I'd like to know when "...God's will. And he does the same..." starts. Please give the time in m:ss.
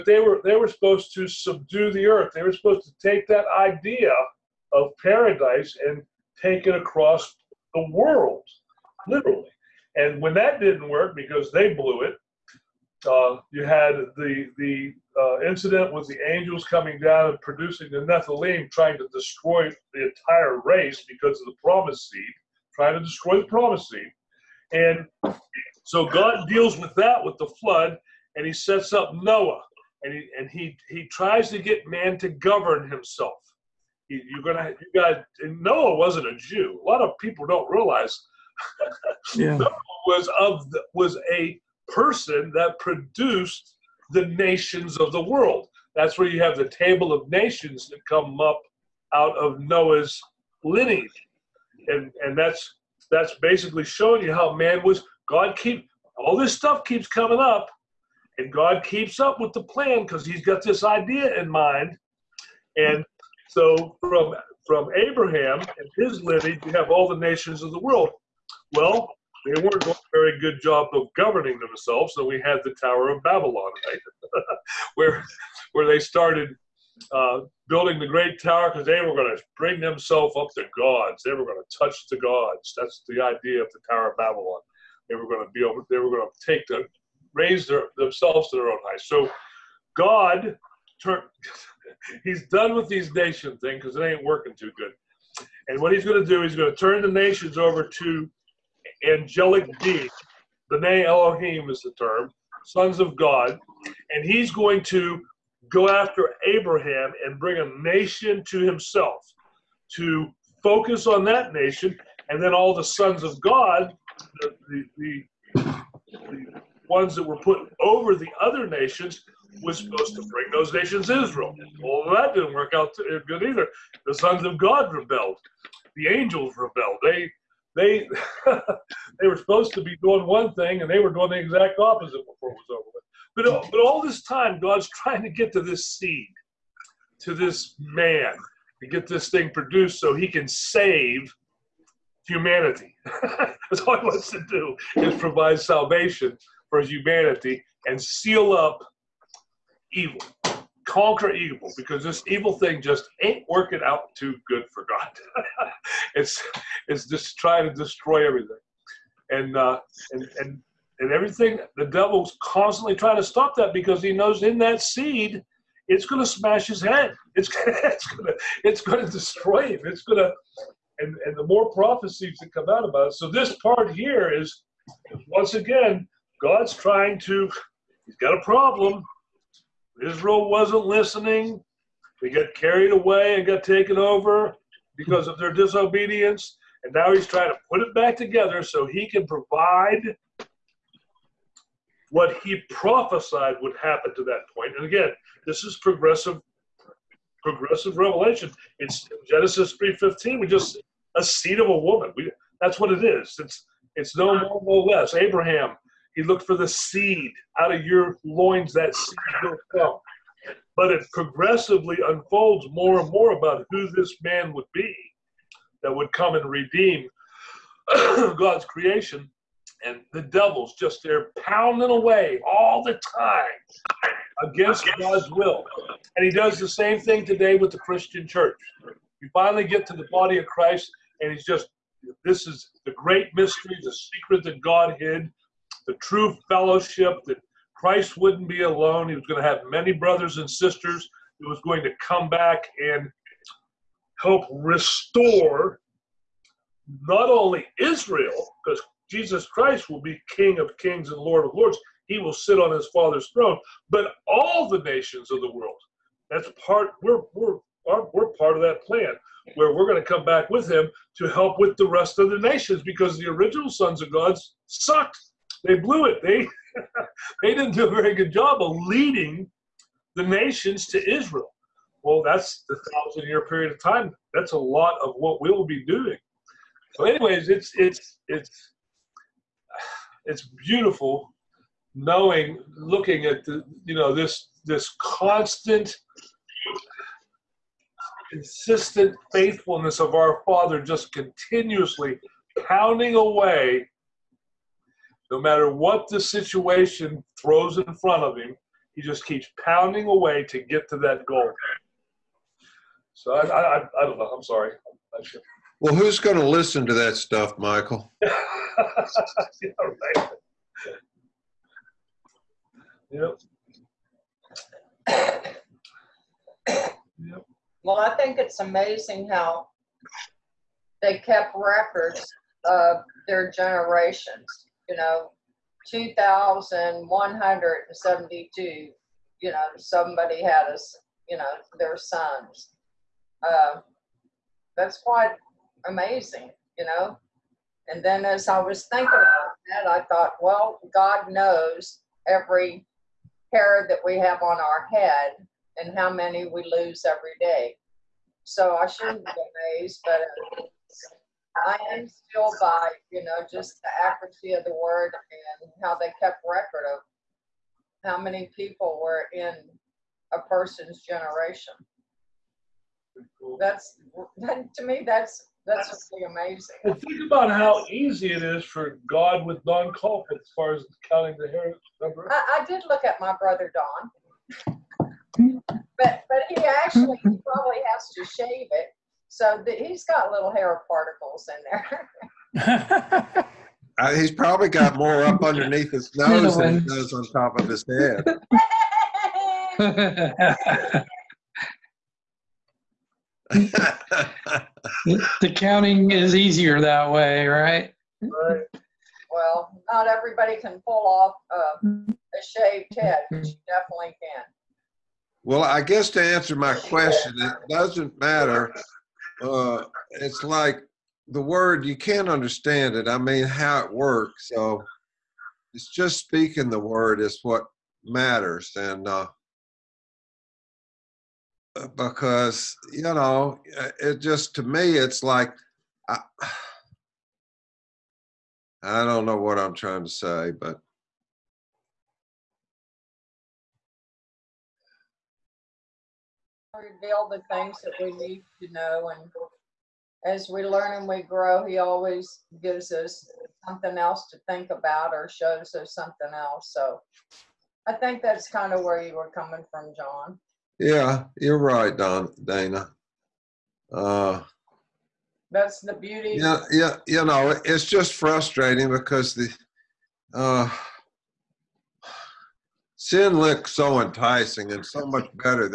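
3:44.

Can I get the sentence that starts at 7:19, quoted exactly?
And as we learn and we grow, He always gives us something else to think about or shows us something else.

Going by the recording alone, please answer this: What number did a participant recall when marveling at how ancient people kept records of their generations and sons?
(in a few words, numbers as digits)
2,172.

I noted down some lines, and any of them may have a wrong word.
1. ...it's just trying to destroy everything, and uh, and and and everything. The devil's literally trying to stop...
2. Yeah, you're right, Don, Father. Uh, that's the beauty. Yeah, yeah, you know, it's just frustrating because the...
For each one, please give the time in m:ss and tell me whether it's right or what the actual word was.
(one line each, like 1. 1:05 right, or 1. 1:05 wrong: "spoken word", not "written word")
1. 2:36 wrong: "constantly", not "literally"
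2. 7:30 wrong: "Dana", not "Father".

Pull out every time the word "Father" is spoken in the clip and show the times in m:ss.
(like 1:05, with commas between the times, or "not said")
4:12, 4:50.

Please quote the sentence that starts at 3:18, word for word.
It's Genesis 3.15, we just a seed of a woman.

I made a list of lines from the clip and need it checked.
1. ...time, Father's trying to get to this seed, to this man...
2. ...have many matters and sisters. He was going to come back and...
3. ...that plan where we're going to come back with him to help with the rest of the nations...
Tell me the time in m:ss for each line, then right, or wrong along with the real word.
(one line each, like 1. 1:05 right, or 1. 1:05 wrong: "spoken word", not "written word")
1. 2:14 wrong: "God", not "Father"
2. 3:59 wrong: "brothers", not "matters"
3. 4:18 right.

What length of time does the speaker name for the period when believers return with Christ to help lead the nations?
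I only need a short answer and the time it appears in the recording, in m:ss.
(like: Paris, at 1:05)
1,000 years, at 4:32.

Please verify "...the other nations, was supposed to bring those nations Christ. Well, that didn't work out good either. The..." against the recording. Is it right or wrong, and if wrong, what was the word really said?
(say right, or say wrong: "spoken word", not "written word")
wrong: "Israel", not "Christ".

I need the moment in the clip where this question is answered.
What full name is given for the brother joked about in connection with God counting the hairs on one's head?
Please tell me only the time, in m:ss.
6:09.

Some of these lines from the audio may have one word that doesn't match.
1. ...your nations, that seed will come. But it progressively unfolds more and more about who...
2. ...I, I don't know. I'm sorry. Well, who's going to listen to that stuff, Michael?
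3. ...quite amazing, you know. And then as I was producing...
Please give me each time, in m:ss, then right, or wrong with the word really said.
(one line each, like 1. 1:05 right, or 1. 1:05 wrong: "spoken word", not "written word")
1. 3:27 wrong: "loins", not "nations"
2. 5:03 right
3. 5:34 wrong: "thinking", not "producing".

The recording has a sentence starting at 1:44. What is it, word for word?
And he's going to go after Abraham and bring a nation to himself to focus on that nation.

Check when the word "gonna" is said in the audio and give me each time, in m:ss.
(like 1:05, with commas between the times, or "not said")
0:34, 2:47.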